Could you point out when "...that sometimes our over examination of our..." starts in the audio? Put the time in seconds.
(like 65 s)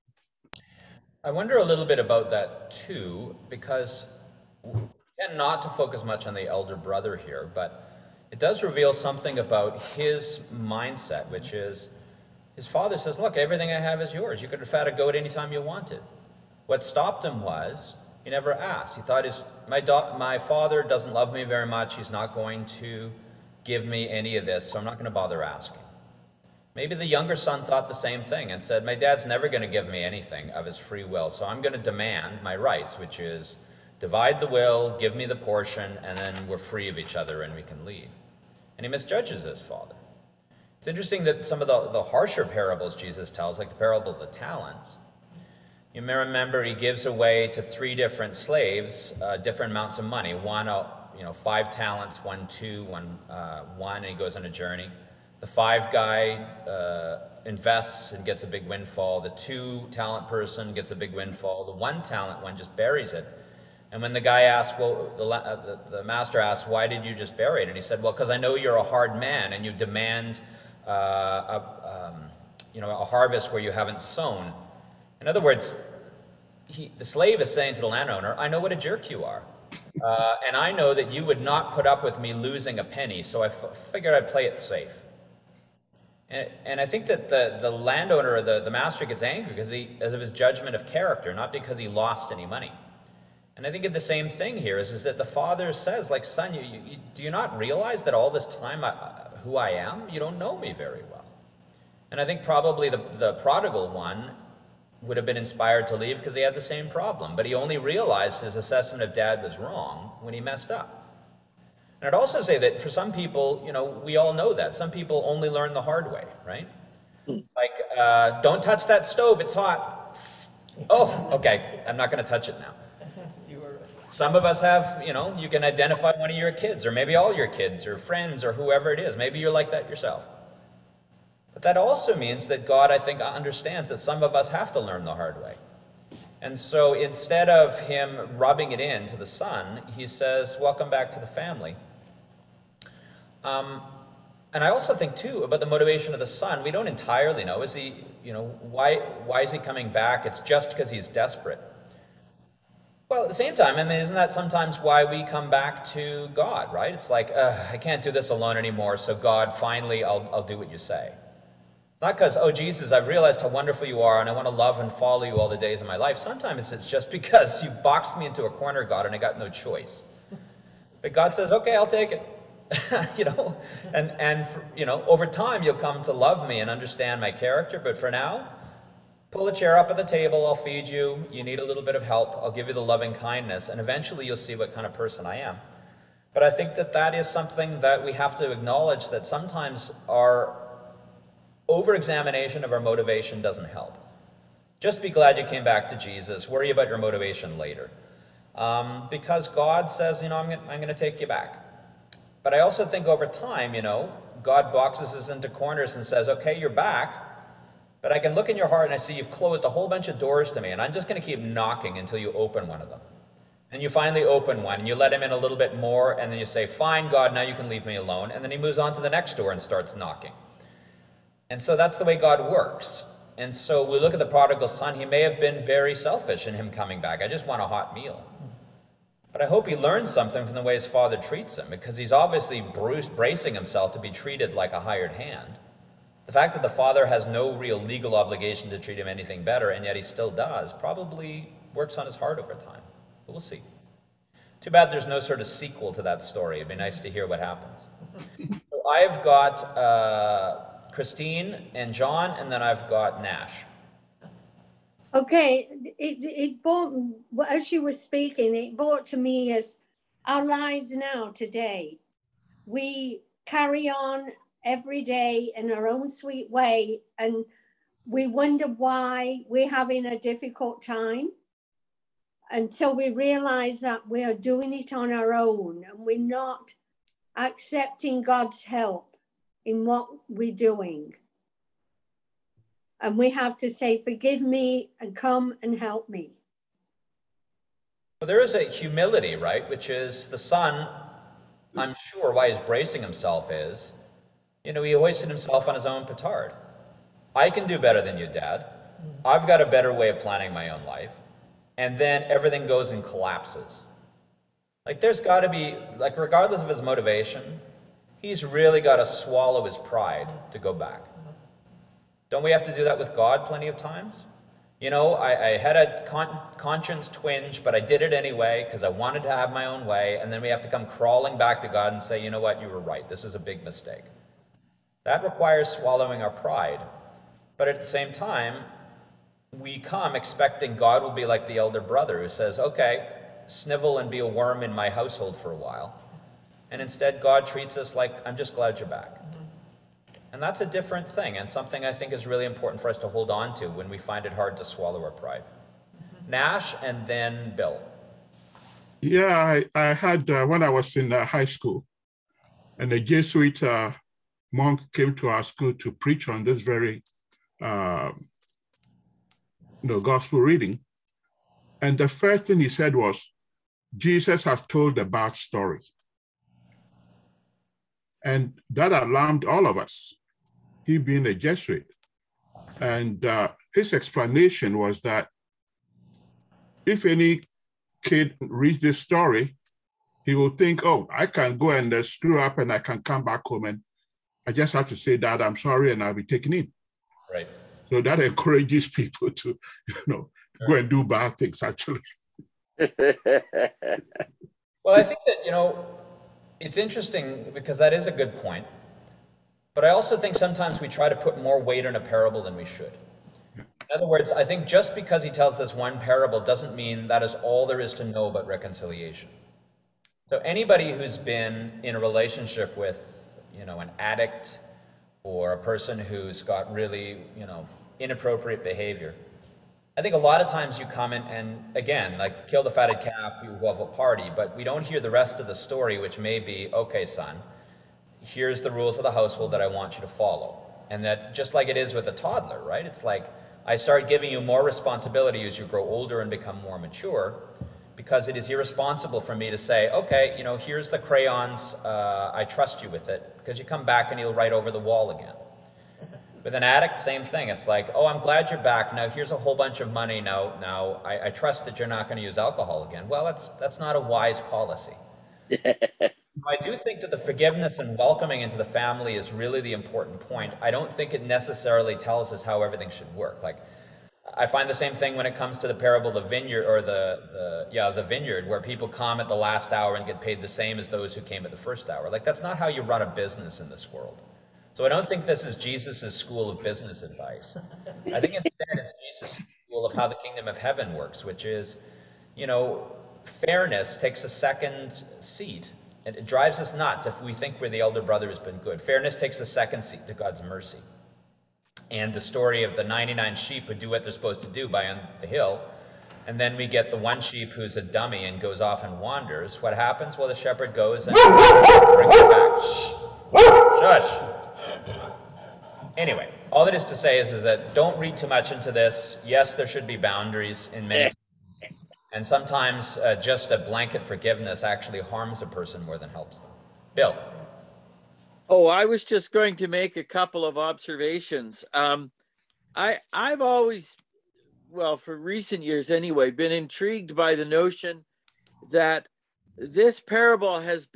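189 s.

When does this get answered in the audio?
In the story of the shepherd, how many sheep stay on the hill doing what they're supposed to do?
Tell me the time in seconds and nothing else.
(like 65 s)
492 s.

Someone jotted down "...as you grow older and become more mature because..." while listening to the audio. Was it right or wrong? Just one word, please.
right.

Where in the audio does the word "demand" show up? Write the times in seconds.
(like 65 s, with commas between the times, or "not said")
31 s, 69 s.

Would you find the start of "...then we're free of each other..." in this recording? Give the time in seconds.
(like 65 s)
36 s.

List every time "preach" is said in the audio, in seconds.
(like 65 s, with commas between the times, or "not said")
355 s.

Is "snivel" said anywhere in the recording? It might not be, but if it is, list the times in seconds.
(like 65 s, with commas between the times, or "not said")
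333 s.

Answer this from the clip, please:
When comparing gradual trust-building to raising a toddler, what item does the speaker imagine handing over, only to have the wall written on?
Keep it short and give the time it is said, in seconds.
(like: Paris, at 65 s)
crayons, at 440 s.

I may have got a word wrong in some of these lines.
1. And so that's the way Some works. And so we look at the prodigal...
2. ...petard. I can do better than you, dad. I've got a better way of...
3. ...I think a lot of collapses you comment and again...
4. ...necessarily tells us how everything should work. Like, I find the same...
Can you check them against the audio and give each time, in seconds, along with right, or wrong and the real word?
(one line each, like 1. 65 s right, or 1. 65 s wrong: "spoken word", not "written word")
1. 221 s wrong: "God", not "Some"
2. 296 s right
3. 419 s wrong: "times", not "collapses"
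4. 461 s right.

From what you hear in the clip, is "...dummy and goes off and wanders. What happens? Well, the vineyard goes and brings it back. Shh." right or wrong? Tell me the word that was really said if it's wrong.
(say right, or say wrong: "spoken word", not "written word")
wrong: "shepherd", not "vineyard".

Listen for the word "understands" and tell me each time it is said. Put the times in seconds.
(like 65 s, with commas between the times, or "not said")
133 s, 176 s.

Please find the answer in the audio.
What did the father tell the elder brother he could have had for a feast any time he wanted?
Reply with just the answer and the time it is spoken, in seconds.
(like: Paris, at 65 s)
a goat, at 14 s.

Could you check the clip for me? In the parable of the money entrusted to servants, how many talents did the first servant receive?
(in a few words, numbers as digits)
5.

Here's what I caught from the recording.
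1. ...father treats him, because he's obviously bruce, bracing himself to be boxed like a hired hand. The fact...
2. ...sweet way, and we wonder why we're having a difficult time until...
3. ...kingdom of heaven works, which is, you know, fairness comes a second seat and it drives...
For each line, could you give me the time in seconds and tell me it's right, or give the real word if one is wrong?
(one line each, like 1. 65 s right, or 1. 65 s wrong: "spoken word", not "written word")
1. 230 s wrong: "treated", not "boxed"
2. 266 s right
3. 480 s wrong: "takes", not "comes".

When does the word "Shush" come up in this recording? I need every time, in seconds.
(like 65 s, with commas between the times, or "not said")
504 s.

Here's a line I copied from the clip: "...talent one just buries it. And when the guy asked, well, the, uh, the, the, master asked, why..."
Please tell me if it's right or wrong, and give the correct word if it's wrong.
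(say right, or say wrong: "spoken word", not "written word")
right.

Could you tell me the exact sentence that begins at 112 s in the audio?
And I'd also say that for some people, you know, we all know that.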